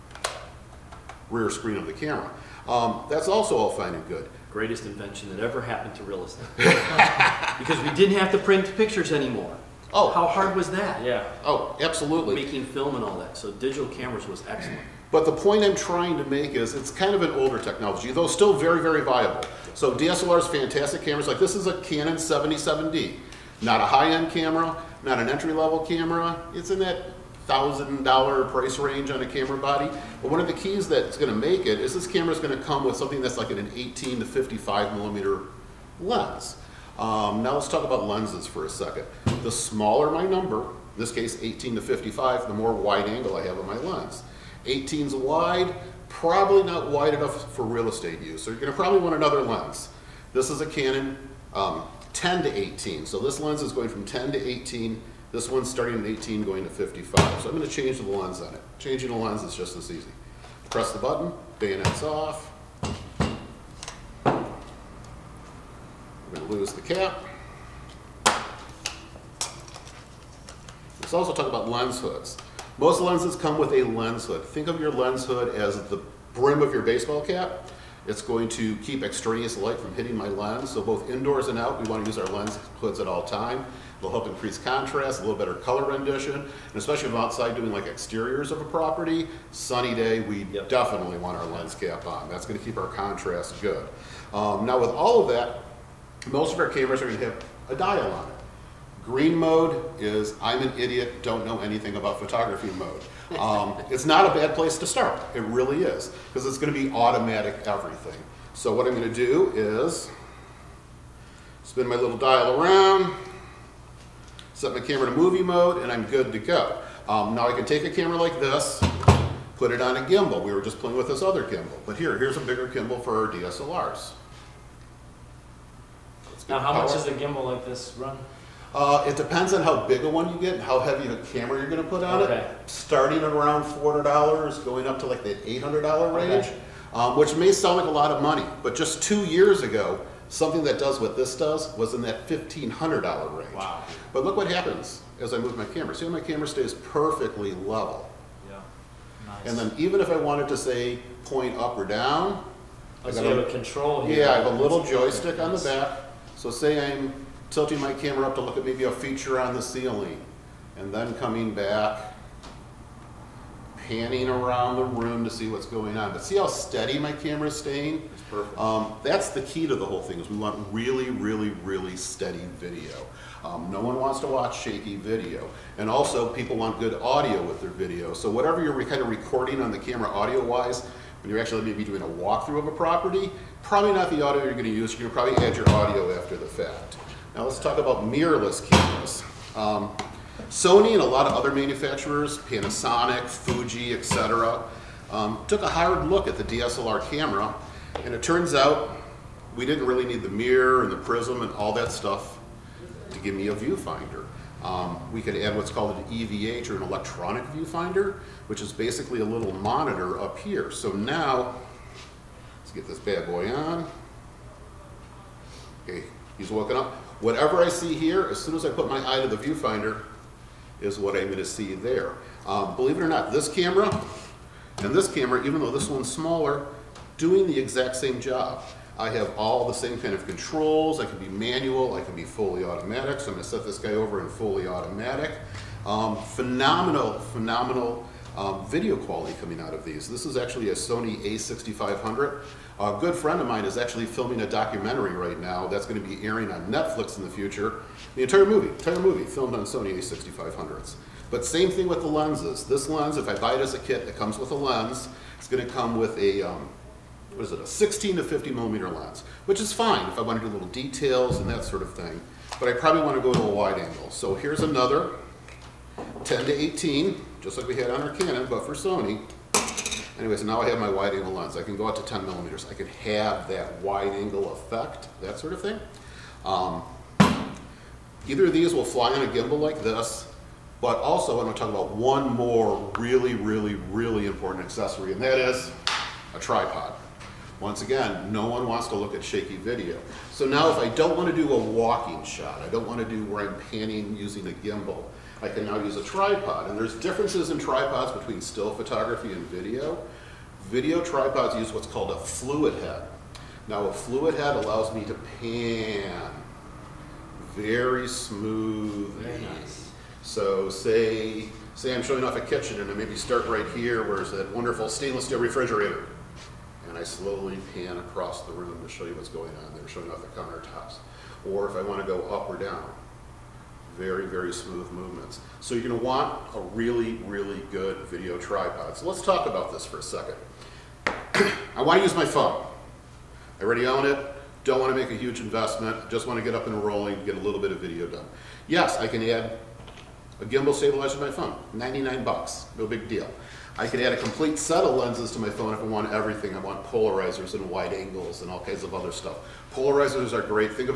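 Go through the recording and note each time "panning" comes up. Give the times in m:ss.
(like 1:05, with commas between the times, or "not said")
2:43, 4:53.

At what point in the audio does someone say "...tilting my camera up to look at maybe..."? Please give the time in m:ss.
2:37.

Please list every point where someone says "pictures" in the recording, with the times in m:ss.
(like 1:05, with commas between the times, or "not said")
0:08.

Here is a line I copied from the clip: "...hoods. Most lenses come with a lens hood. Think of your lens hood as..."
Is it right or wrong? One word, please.
right.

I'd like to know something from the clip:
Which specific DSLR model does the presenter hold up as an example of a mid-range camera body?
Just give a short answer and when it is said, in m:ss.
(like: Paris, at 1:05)
Canon 77D, at 0:21.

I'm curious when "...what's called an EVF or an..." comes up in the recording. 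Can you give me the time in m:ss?
3:25.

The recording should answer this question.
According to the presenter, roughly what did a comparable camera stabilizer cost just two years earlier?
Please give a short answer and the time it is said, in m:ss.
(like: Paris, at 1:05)
$1,500, at 2:22.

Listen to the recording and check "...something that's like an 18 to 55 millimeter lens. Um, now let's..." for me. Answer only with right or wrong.
right.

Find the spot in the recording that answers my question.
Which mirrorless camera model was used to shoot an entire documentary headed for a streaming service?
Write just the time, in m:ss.
4:00.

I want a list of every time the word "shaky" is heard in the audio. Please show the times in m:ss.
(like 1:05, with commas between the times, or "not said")
2:54, 4:49.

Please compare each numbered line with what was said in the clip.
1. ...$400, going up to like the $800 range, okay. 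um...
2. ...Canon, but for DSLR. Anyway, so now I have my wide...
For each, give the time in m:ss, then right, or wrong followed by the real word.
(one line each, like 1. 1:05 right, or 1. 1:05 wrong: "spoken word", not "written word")
1. 2:13 right
2. 4:28 wrong: "Sony", not "DSLR".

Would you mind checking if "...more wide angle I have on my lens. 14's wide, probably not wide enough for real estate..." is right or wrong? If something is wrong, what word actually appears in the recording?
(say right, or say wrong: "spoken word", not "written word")
wrong: "18", not "14".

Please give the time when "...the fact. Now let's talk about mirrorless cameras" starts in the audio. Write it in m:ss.
3:06.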